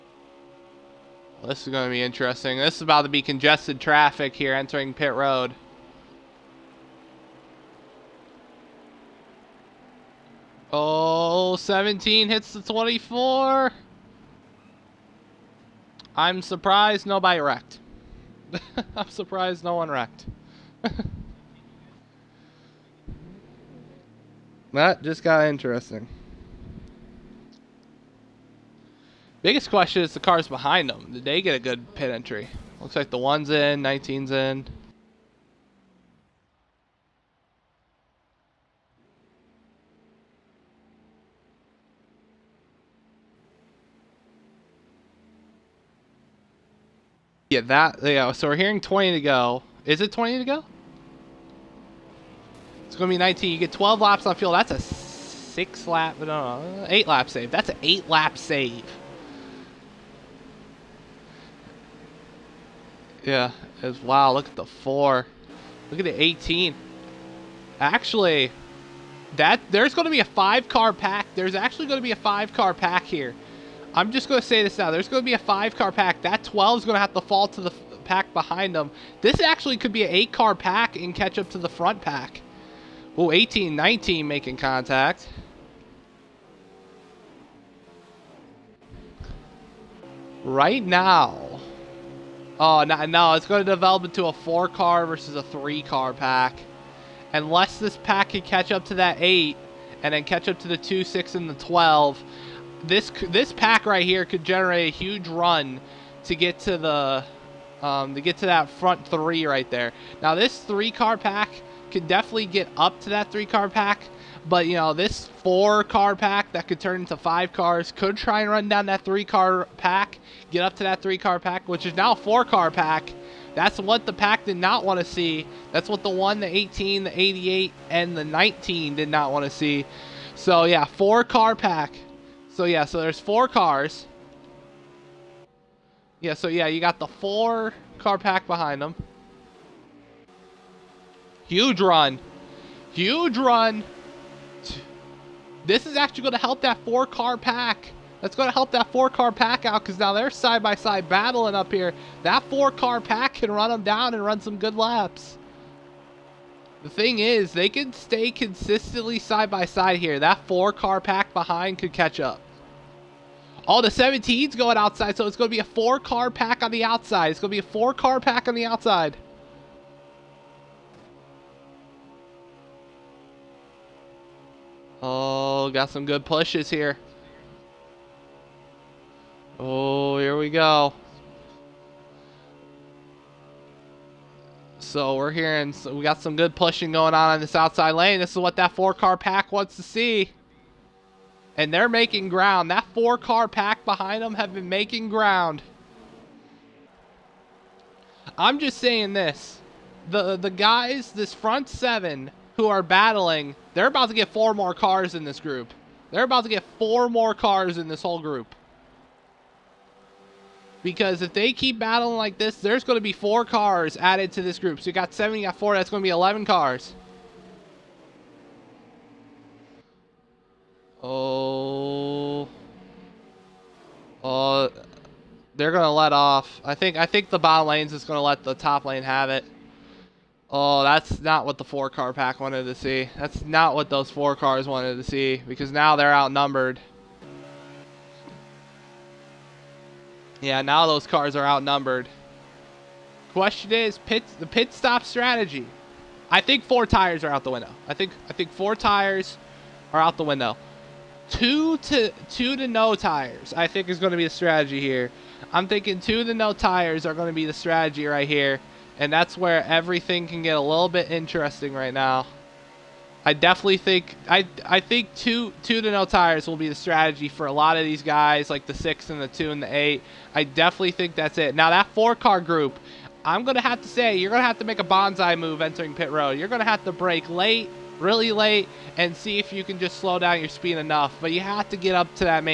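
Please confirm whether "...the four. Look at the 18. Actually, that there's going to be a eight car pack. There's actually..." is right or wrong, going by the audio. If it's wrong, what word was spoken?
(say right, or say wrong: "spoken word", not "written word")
wrong: "five", not "eight".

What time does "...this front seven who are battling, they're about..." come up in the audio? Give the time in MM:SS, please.
03:21.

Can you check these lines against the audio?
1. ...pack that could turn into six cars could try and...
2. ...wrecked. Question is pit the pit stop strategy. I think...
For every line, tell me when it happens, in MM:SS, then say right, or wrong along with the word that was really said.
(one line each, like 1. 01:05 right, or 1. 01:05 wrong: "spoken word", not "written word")
1. 01:56 wrong: "five", not "six"
2. 04:01 wrong: "outnumbered", not "wrecked".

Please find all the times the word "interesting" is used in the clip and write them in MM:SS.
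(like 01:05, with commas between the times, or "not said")
00:02, 00:25, 04:21.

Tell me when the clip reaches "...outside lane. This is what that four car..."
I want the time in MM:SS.
03:07.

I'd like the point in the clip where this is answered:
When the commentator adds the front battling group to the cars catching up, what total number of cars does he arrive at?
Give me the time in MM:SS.
03:36.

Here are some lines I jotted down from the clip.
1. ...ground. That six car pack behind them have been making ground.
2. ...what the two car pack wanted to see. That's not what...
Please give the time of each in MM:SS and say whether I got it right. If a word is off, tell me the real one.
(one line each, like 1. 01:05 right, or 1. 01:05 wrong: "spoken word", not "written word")
1. 03:12 wrong: "four", not "six"
2. 03:51 wrong: "four", not "two".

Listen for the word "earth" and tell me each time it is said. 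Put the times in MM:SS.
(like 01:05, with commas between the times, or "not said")
not said.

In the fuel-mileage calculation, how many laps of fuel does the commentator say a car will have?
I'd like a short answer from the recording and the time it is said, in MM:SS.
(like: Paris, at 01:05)
12, at 00:53.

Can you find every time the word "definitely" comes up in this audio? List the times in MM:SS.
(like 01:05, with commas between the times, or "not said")
01:52, 04:23, 04:30.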